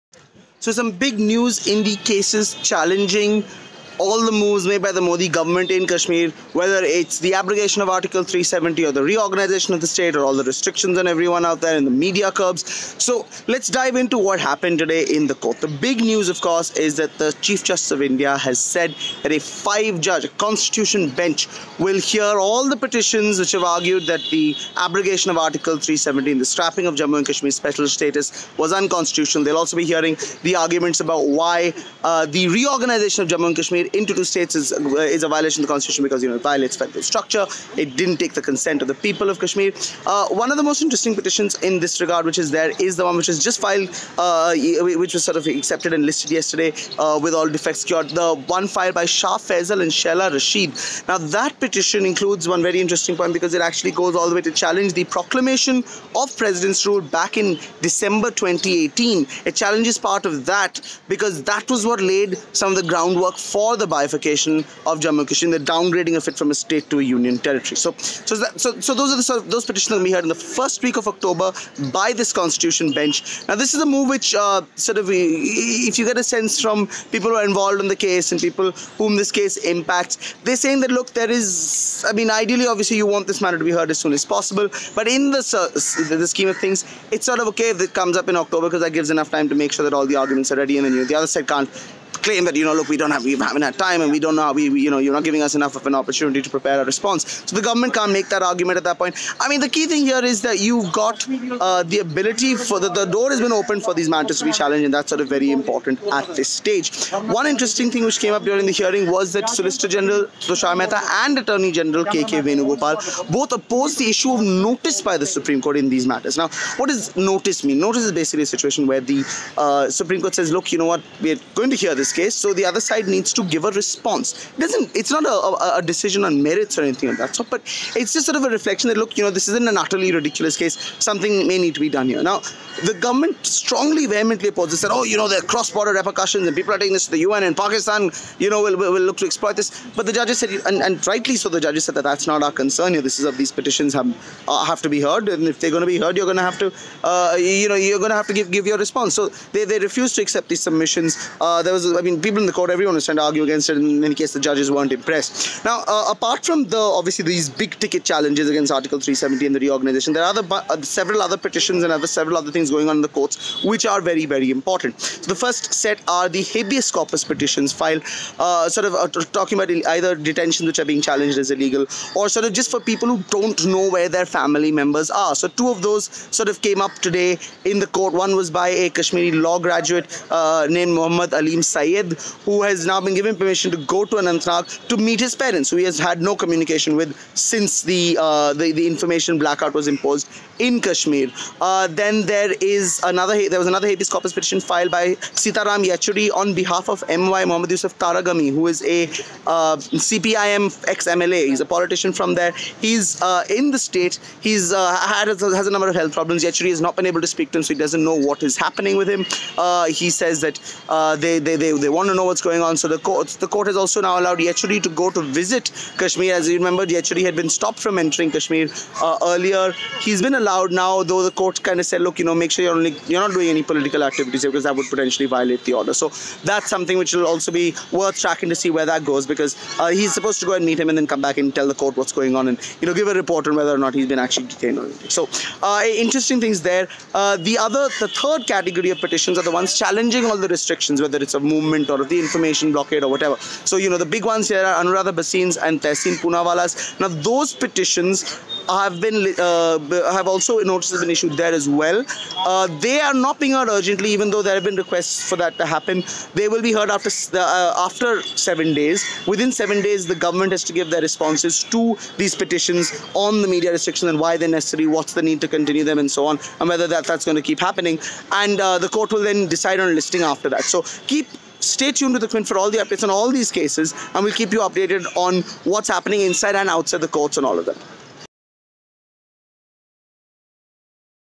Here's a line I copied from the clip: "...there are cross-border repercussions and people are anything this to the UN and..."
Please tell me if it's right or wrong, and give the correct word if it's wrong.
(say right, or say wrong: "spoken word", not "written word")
wrong: "taking", not "anything".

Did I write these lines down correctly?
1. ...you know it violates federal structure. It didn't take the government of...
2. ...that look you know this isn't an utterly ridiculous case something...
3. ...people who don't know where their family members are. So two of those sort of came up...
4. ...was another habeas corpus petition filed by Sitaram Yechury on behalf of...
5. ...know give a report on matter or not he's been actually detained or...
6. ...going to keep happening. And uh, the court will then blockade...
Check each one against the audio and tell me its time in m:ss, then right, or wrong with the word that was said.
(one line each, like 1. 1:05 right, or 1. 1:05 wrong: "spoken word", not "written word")
1. 0:36 wrong: "consent", not "government"
2. 2:08 right
3. 2:52 right
4. 3:13 right
5. 3:52 wrong: "whether", not "matter"
6. 4:27 wrong: "decide", not "blockade".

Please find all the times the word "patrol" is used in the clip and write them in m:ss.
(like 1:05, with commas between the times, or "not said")
not said.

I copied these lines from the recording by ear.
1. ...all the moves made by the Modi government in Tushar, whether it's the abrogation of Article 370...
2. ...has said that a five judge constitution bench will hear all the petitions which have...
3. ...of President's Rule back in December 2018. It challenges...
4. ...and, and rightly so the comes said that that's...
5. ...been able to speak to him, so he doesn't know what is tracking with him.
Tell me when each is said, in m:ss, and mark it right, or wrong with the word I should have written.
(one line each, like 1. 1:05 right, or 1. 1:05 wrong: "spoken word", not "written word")
1. 0:04 wrong: "Kashmir", not "Tushar"
2. 0:18 right
3. 0:56 right
4. 2:20 wrong: "judges", not "comes"
5. 3:26 wrong: "happening", not "tracking".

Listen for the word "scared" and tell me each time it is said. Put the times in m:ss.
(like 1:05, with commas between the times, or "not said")
not said.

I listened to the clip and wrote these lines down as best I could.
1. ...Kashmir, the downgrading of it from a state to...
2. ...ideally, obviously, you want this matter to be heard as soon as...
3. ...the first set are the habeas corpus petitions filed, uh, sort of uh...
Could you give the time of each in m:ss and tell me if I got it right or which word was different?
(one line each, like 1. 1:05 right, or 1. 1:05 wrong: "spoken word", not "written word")
1. 1:05 right
2. 1:22 right
3. 2:45 right.